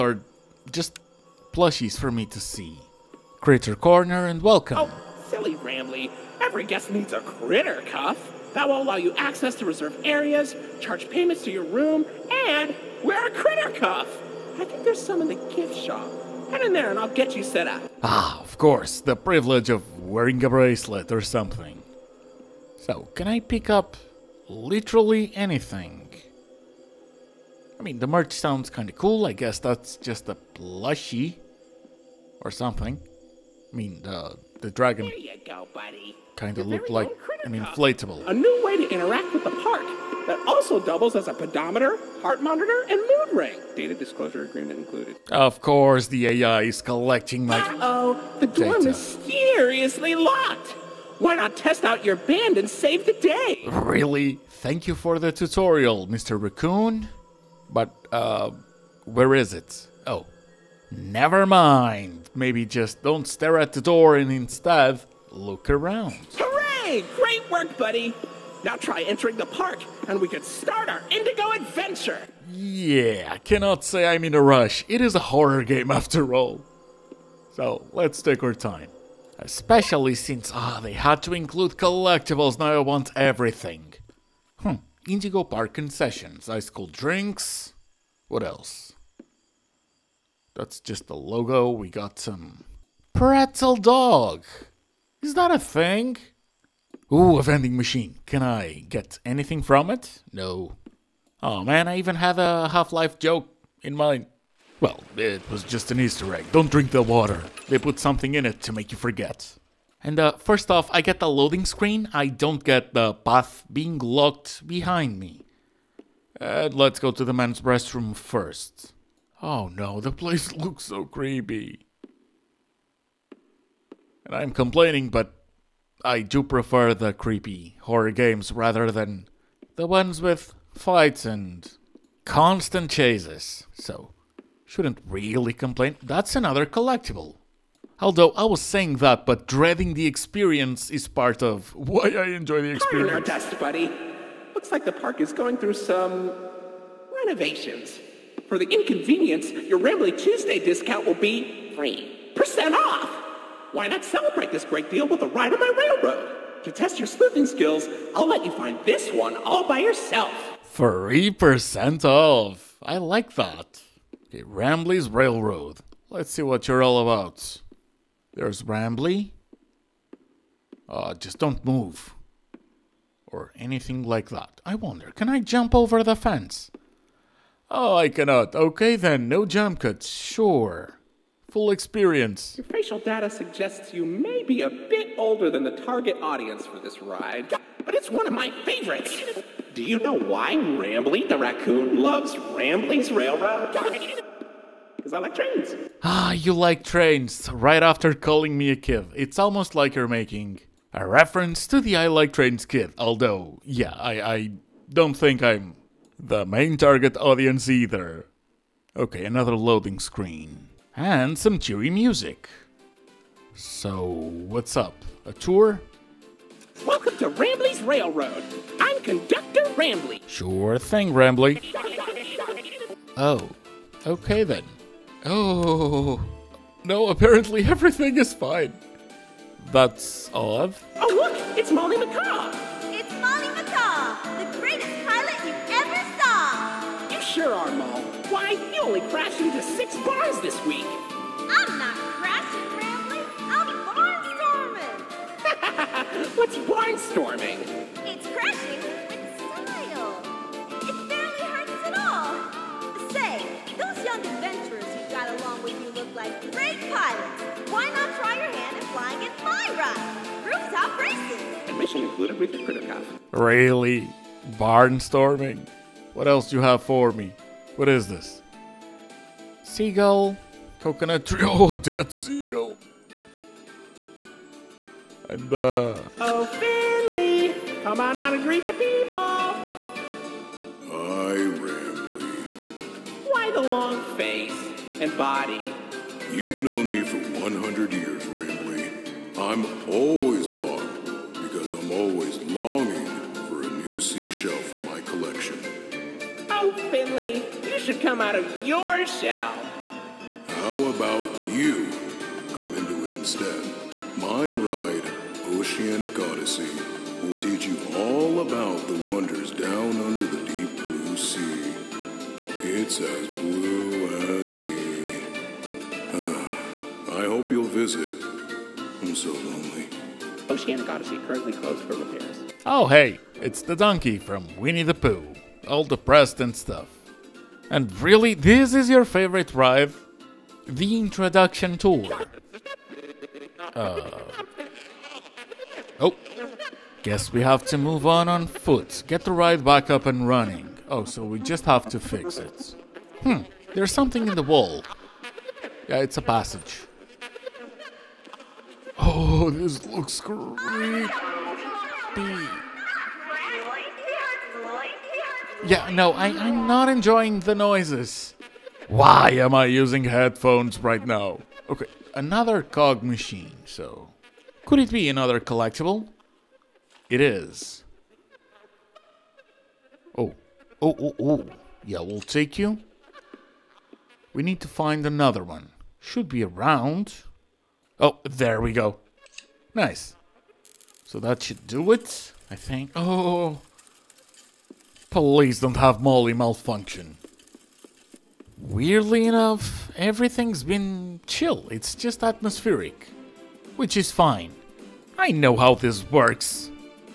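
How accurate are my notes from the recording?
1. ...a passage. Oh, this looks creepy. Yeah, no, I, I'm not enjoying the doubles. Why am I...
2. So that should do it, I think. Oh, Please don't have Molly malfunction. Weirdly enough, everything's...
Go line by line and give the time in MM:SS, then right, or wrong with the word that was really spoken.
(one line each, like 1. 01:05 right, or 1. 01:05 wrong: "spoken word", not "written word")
1. 05:46 wrong: "noises", not "doubles"
2. 06:21 right.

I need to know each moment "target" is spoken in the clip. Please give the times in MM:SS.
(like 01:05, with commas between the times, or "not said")
03:05, 03:26.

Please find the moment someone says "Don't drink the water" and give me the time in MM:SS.
01:46.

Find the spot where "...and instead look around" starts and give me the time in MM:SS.
01:04.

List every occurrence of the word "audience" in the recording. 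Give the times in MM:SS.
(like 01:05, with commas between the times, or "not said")
03:06, 03:27.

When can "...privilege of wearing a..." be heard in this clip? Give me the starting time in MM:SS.
00:19.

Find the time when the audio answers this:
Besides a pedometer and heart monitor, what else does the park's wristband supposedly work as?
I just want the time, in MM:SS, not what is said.
00:43.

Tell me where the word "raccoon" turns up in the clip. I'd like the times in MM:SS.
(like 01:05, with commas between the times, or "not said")
00:56, 03:11.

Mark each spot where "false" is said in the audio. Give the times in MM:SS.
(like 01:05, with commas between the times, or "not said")
not said.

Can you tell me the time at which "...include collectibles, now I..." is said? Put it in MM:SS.
01:21.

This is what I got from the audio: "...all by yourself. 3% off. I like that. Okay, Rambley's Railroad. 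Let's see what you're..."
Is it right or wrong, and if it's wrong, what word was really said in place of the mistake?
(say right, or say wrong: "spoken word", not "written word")
right.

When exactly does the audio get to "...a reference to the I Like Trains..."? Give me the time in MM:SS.
03:20.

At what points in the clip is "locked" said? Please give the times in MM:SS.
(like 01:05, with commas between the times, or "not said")
00:50, 01:53.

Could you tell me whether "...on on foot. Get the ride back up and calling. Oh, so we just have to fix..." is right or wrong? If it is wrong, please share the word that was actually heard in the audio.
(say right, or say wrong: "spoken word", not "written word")
wrong: "running", not "calling".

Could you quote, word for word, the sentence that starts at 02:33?
Why not celebrate this great deal with a ride on my railroad?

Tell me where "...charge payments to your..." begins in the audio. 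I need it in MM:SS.
00:10.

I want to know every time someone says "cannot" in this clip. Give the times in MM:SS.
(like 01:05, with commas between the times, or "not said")
01:13, 02:58.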